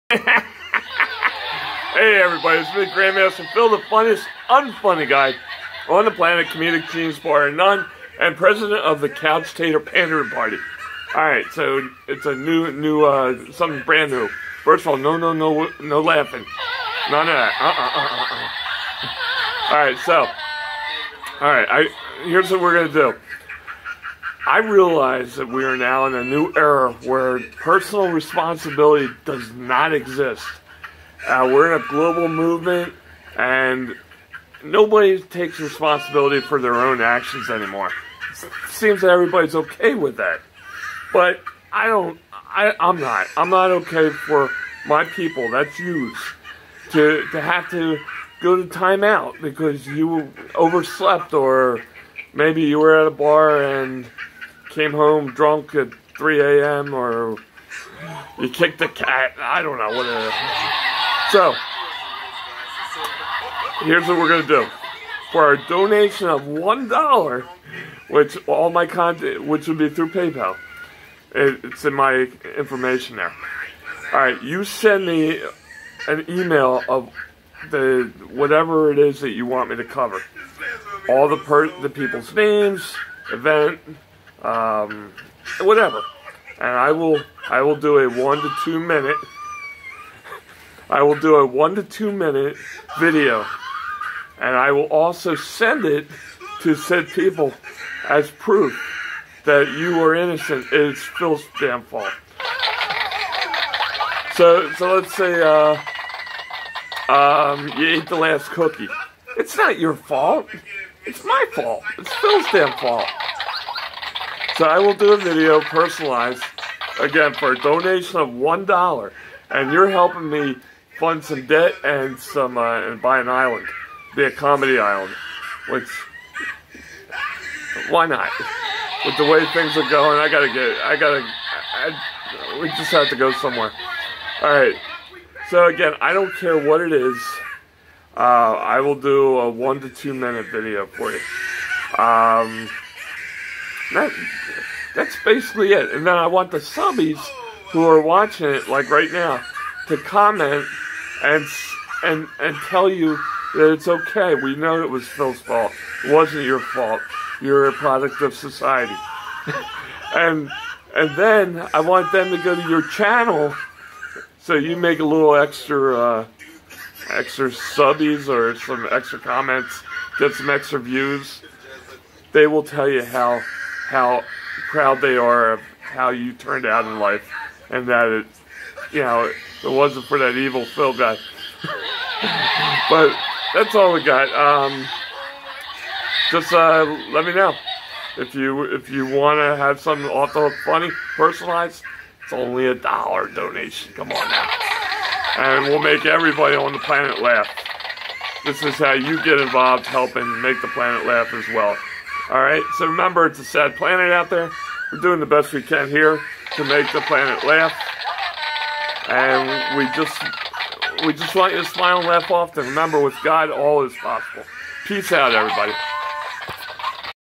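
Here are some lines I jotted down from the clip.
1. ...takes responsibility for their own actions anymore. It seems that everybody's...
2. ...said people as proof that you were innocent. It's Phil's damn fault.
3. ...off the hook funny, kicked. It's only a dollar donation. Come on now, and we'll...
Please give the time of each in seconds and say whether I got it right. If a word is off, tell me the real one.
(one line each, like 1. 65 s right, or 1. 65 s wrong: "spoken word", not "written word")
1. 35 s right
2. 96 s right
3. 190 s wrong: "personalized", not "kicked".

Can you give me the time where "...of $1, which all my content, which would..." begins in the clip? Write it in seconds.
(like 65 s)
66 s.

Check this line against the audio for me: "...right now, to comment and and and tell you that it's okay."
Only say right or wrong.
right.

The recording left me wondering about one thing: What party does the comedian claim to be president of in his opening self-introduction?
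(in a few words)
Couch Tater Pandering Party.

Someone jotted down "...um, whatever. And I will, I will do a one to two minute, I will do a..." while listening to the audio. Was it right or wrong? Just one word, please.
right.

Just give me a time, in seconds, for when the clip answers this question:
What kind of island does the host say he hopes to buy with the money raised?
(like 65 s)
124 s.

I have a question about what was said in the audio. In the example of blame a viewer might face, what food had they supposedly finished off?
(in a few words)
cookie.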